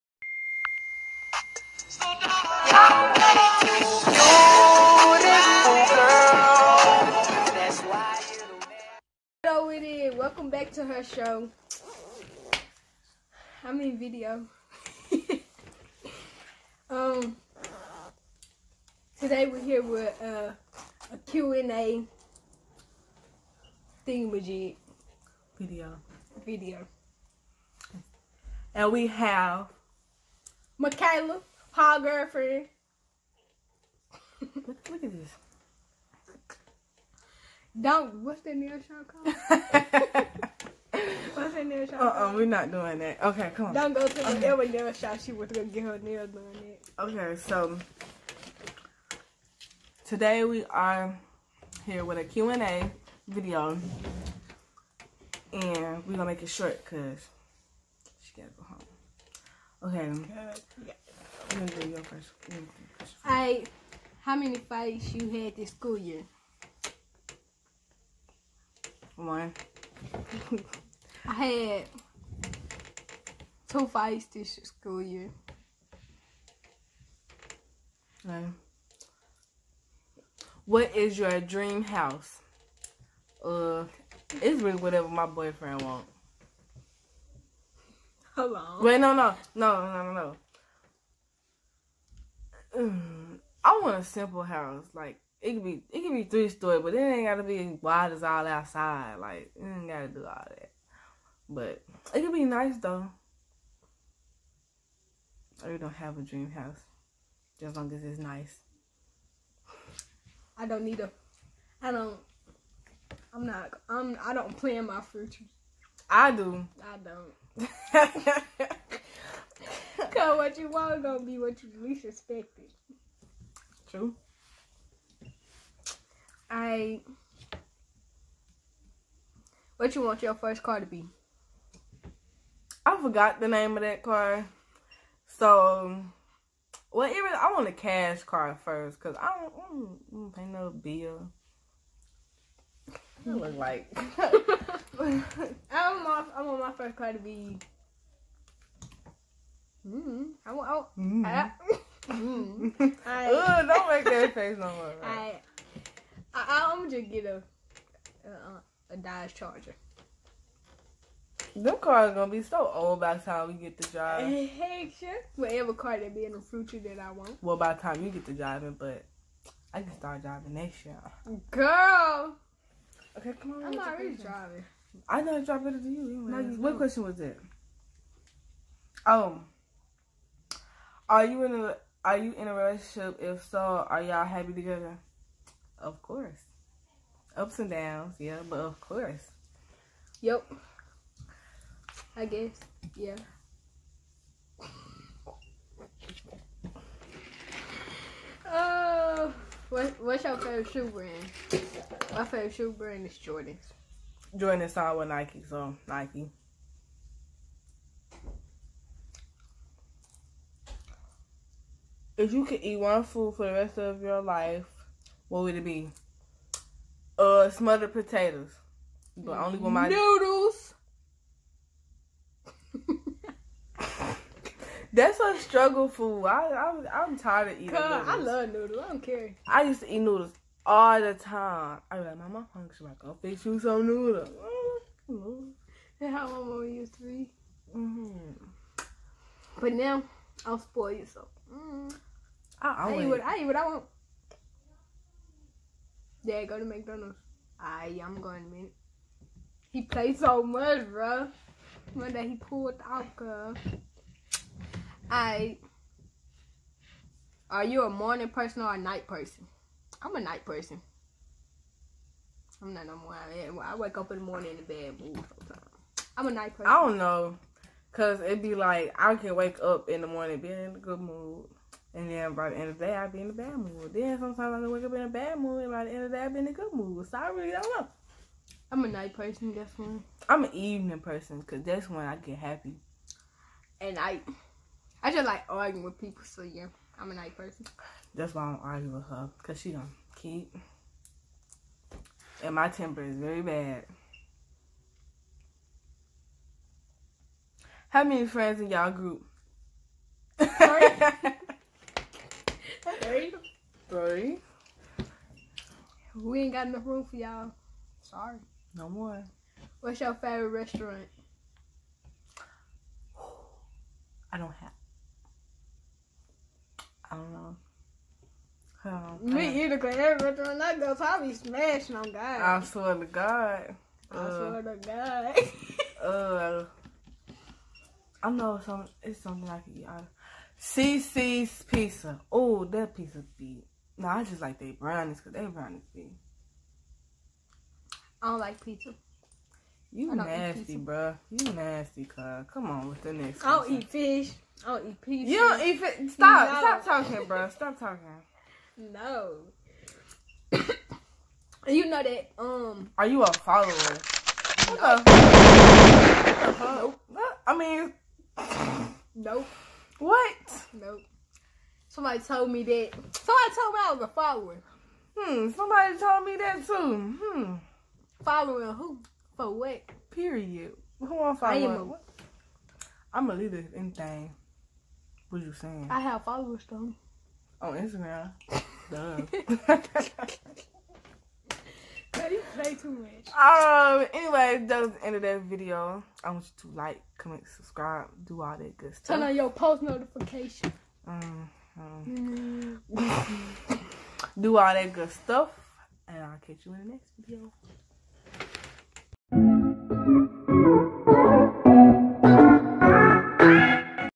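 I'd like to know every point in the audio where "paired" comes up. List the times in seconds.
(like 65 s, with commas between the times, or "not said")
not said.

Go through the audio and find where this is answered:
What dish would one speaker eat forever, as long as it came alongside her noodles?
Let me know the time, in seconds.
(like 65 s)
217 s.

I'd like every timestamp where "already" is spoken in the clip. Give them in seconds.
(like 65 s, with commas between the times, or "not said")
173 s.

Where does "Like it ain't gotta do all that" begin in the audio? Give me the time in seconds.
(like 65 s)
99 s.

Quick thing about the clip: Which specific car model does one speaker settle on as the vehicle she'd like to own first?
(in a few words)
Dodge Charger.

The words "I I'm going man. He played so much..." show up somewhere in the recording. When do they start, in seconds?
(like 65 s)
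247 s.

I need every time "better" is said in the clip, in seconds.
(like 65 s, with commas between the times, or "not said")
175 s.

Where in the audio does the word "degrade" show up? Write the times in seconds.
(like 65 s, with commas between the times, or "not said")
not said.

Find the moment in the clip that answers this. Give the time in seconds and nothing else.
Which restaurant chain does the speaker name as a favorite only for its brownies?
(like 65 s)
330 s.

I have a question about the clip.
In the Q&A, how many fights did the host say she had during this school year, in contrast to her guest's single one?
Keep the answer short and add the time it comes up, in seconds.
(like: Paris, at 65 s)
2, at 73 s.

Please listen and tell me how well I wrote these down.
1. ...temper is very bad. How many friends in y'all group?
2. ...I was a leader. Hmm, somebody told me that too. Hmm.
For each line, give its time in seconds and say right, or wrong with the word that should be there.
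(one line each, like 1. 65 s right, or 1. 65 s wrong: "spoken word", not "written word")
1. 292 s right
2. 363 s wrong: "follower", not "leader".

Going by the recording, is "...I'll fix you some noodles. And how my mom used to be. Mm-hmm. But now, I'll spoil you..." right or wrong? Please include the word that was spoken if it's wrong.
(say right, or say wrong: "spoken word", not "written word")
right.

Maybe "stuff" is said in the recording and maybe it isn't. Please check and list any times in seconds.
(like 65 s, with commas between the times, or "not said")
388 s, 395 s.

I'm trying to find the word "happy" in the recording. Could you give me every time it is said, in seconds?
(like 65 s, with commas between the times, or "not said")
184 s, 282 s.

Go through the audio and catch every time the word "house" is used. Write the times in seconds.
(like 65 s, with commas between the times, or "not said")
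81 s, 94 s, 106 s.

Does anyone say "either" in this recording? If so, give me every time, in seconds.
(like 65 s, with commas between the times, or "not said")
319 s.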